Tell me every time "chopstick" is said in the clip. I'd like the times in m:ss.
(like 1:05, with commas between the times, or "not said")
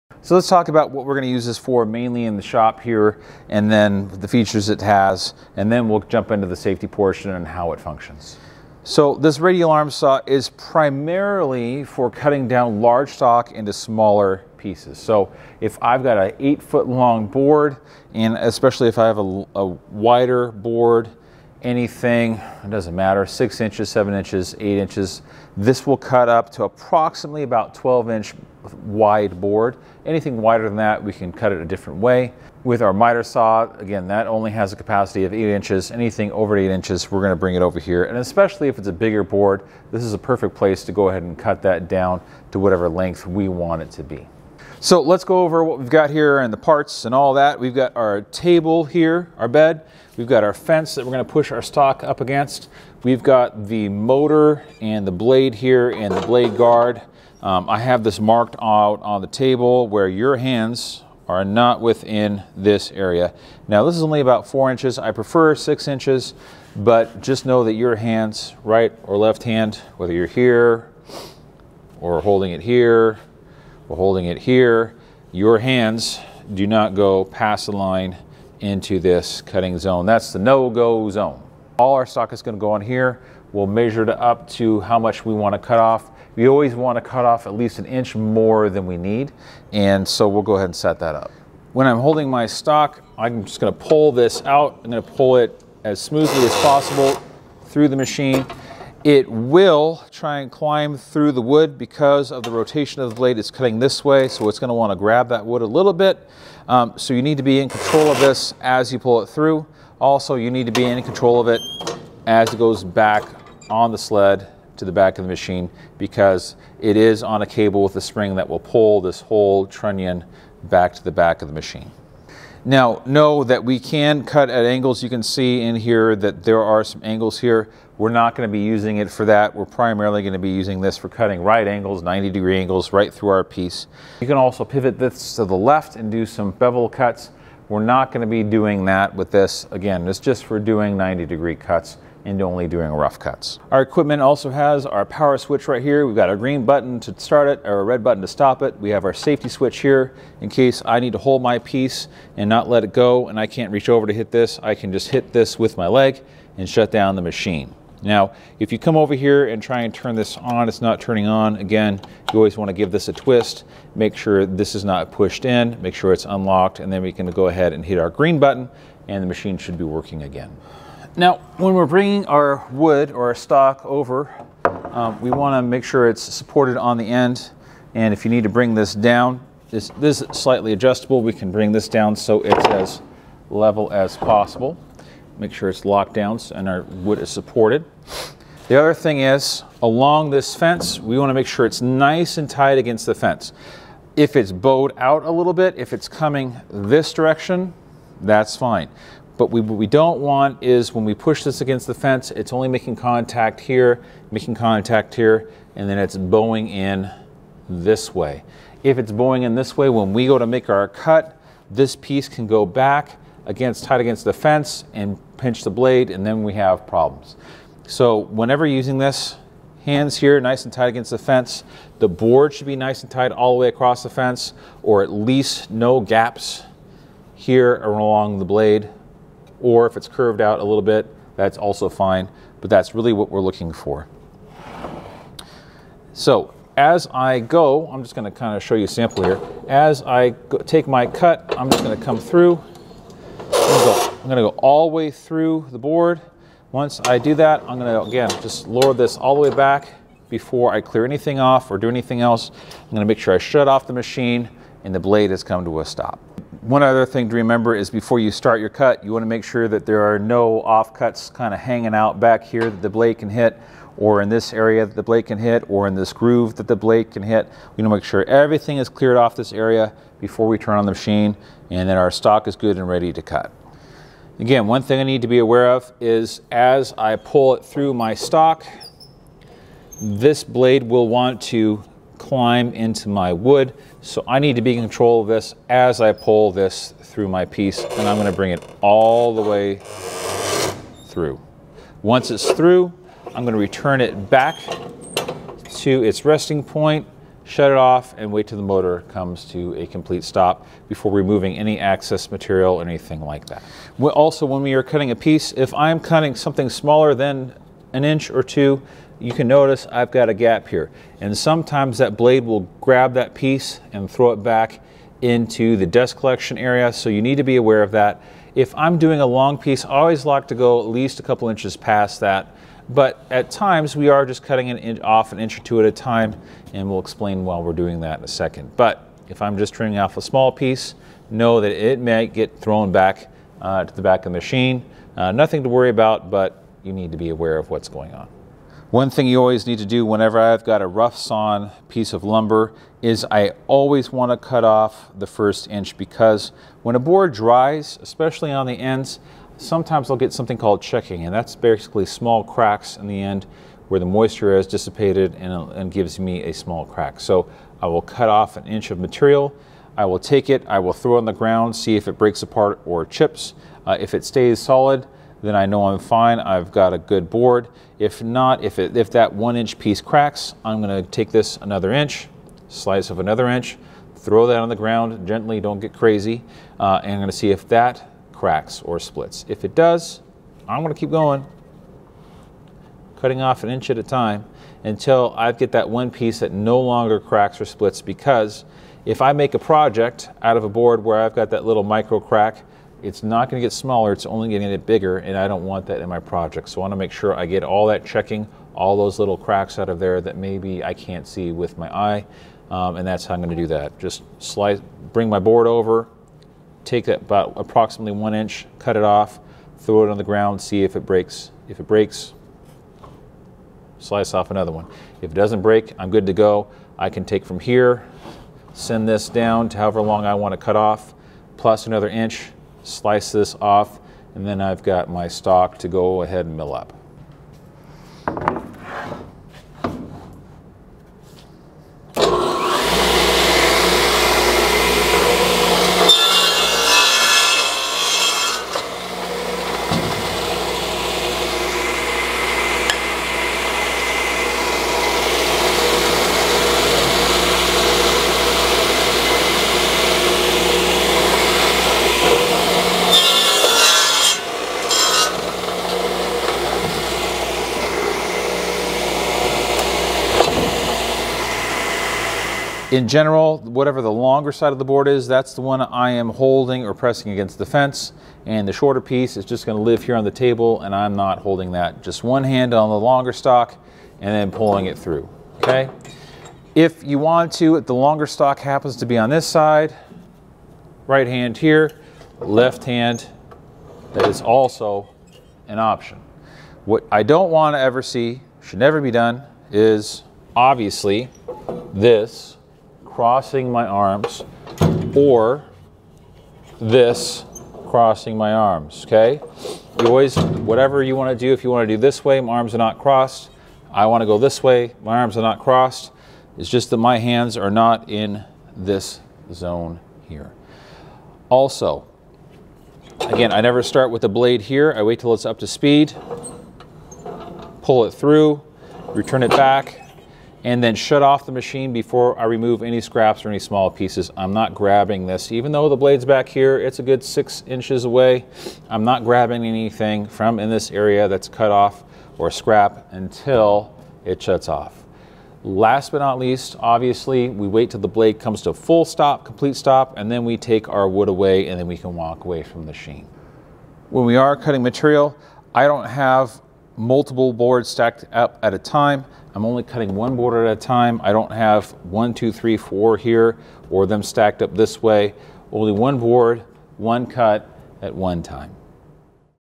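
not said.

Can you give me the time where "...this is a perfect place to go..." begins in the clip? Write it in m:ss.
0:39.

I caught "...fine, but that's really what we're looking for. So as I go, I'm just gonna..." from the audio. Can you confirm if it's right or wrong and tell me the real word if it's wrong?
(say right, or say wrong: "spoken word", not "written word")
right.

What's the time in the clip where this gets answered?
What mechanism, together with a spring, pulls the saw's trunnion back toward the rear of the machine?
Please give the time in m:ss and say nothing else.
1:57.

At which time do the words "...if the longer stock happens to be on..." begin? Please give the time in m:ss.
7:57.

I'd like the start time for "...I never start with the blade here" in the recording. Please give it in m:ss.
8:33.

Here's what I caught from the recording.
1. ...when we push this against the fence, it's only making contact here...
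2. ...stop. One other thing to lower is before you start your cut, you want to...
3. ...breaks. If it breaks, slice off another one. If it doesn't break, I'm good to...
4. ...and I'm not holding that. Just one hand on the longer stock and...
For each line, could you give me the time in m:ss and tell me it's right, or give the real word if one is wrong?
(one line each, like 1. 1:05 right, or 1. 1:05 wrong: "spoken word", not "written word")
1. 3:20 right
2. 4:15 wrong: "remember", not "lower"
3. 6:51 right
4. 7:50 right.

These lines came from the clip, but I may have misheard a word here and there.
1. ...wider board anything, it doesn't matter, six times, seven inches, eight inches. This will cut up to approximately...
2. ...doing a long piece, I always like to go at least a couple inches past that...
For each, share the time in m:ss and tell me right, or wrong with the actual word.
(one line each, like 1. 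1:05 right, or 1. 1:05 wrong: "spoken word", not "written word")
1. 0:19 wrong: "inches", not "times"
2. 5:18 right.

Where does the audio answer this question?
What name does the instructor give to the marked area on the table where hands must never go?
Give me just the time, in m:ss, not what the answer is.
1:20.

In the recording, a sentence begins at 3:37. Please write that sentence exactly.
So whenever using this, hands here nice and tight against the fence.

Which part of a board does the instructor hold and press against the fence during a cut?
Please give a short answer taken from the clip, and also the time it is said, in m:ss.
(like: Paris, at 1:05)
the longer side, at 7:44.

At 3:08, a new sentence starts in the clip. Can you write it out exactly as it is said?
The other thing is, along this fence, we want to make sure it's nice and tight against the fence.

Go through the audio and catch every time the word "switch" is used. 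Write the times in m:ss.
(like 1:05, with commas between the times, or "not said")
2:25, 2:29.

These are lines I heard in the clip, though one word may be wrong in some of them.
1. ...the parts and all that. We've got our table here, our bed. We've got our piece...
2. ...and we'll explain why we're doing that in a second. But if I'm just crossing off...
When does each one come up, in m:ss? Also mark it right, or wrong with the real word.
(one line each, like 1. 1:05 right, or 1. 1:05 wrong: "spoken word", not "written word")
1. 0:46 wrong: "fence", not "piece"
2. 5:26 wrong: "trimming", not "crossing".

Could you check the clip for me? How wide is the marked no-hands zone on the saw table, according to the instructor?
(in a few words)
about 4 inches.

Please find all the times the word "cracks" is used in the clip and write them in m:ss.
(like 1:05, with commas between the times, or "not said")
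5:52, 5:56, 6:09, 6:18, 6:27, 6:32, 6:39.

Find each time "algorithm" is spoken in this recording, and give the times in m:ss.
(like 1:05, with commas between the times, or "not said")
not said.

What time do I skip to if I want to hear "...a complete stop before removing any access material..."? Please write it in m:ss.
4:59.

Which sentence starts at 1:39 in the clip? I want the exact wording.
It will try and climb through the wood because of the rotation of the blade.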